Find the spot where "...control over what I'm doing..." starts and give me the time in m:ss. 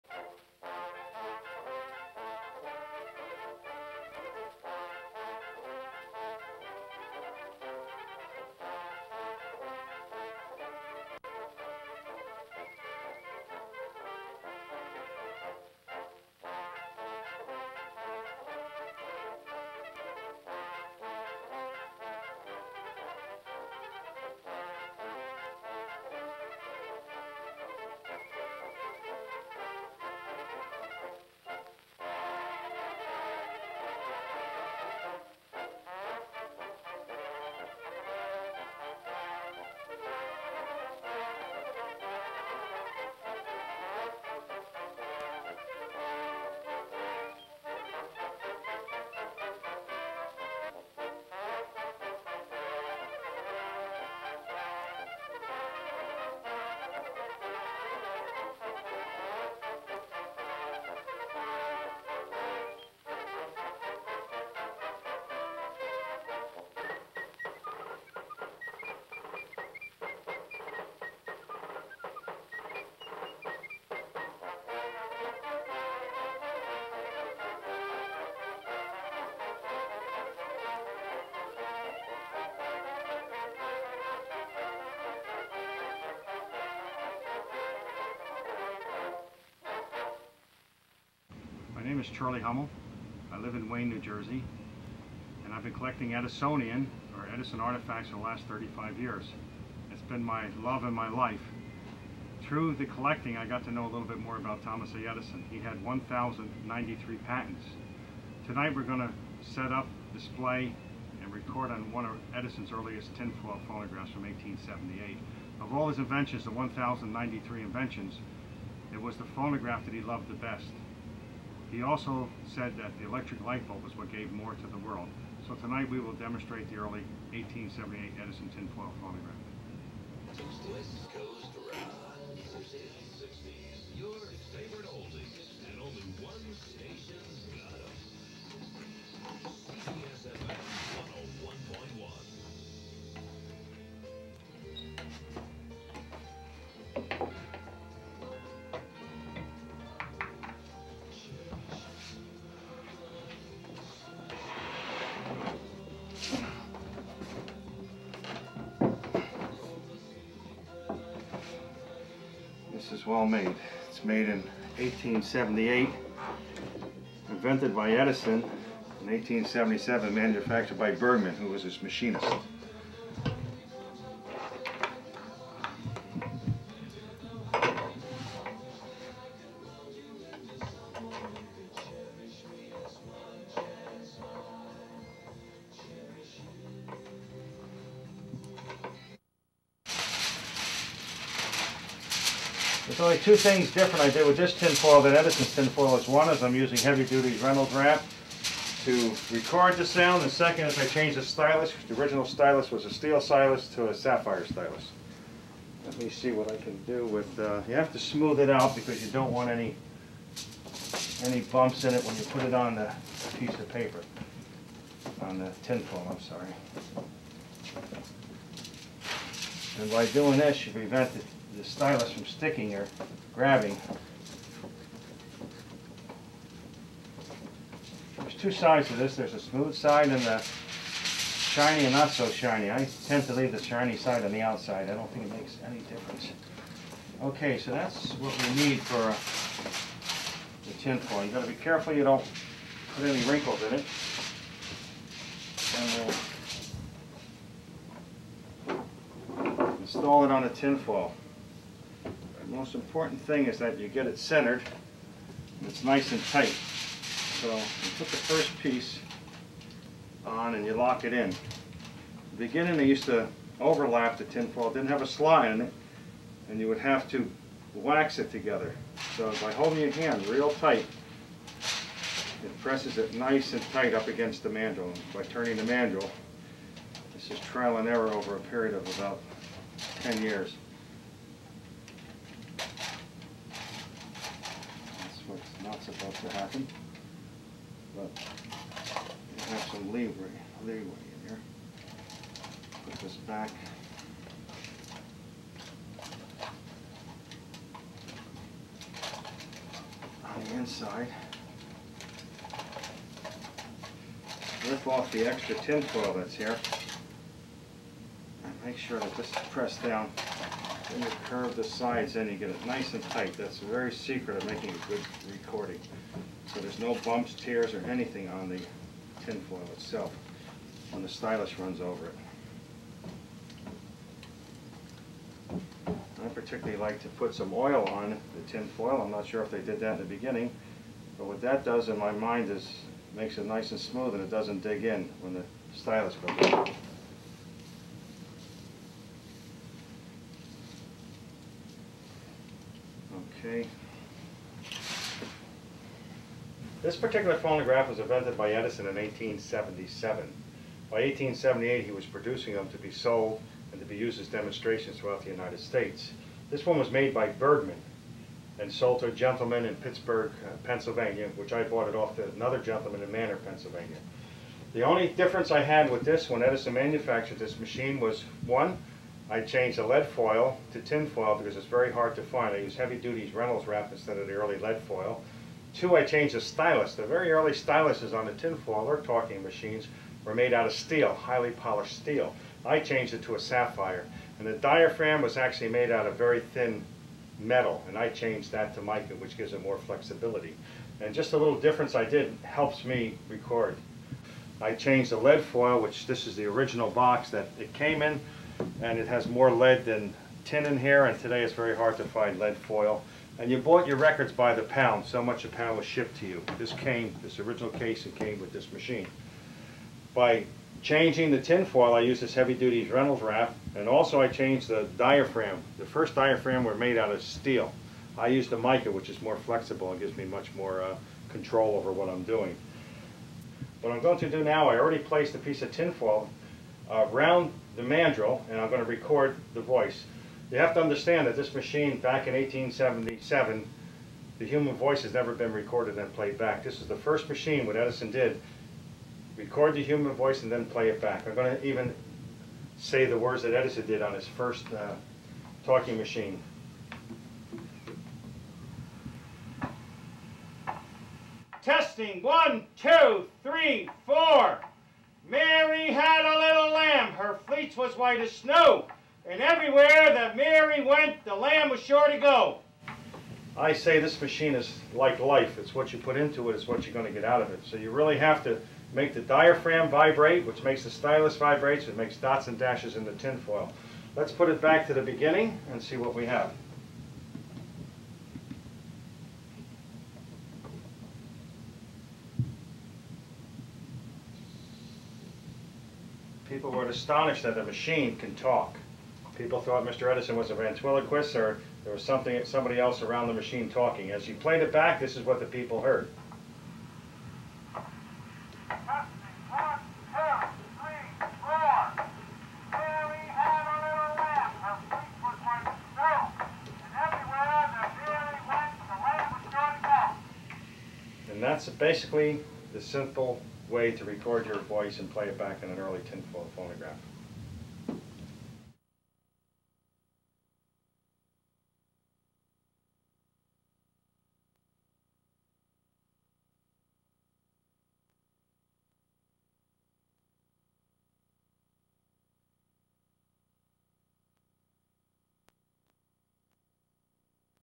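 7:01.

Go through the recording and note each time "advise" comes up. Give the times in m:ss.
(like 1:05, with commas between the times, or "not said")
not said.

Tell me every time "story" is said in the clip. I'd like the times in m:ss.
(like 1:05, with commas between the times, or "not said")
not said.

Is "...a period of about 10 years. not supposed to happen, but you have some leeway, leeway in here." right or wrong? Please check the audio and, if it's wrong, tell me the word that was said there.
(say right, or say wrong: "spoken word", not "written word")
right.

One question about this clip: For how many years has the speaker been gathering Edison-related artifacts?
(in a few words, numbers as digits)
35.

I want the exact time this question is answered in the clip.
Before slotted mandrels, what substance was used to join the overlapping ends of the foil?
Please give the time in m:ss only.
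4:27.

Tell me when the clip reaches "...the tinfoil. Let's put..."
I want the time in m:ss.
7:53.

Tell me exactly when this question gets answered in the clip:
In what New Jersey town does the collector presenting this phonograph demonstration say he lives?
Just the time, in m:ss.
1:33.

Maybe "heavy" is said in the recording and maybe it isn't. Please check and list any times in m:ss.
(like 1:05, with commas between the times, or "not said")
3:16, 6:12, 6:52.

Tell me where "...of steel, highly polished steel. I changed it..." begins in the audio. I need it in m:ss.
6:20.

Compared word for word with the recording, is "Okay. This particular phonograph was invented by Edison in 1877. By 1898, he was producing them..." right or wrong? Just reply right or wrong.
wrong.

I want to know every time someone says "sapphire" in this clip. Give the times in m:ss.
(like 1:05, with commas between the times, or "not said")
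3:23, 6:23.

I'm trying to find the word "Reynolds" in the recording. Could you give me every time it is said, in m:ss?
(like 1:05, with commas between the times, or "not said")
3:17, 6:13, 6:52.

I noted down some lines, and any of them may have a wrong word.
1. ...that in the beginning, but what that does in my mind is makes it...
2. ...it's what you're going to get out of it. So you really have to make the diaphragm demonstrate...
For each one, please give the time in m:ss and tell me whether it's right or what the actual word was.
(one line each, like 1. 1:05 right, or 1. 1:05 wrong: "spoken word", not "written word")
1. 5:29 right
2. 7:46 wrong: "vibrate", not "demonstrate".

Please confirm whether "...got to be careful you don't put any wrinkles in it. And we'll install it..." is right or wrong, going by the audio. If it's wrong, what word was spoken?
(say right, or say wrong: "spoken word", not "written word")
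right.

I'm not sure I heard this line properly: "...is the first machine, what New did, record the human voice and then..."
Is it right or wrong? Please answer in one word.
wrong.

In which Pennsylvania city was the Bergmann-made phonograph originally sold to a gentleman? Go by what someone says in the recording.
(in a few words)
Pittsburgh.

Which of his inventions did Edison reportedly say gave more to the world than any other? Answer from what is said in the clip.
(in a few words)
electric light bulb.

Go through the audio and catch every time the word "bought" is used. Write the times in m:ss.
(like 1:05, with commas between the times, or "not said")
6:01, 6:43.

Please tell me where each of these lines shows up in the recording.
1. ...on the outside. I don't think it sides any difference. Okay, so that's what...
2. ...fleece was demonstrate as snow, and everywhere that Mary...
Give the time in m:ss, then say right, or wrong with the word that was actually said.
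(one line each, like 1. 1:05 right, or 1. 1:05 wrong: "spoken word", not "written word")
1. 3:54 wrong: "makes", not "sides"
2. 7:37 wrong: "white", not "demonstrate".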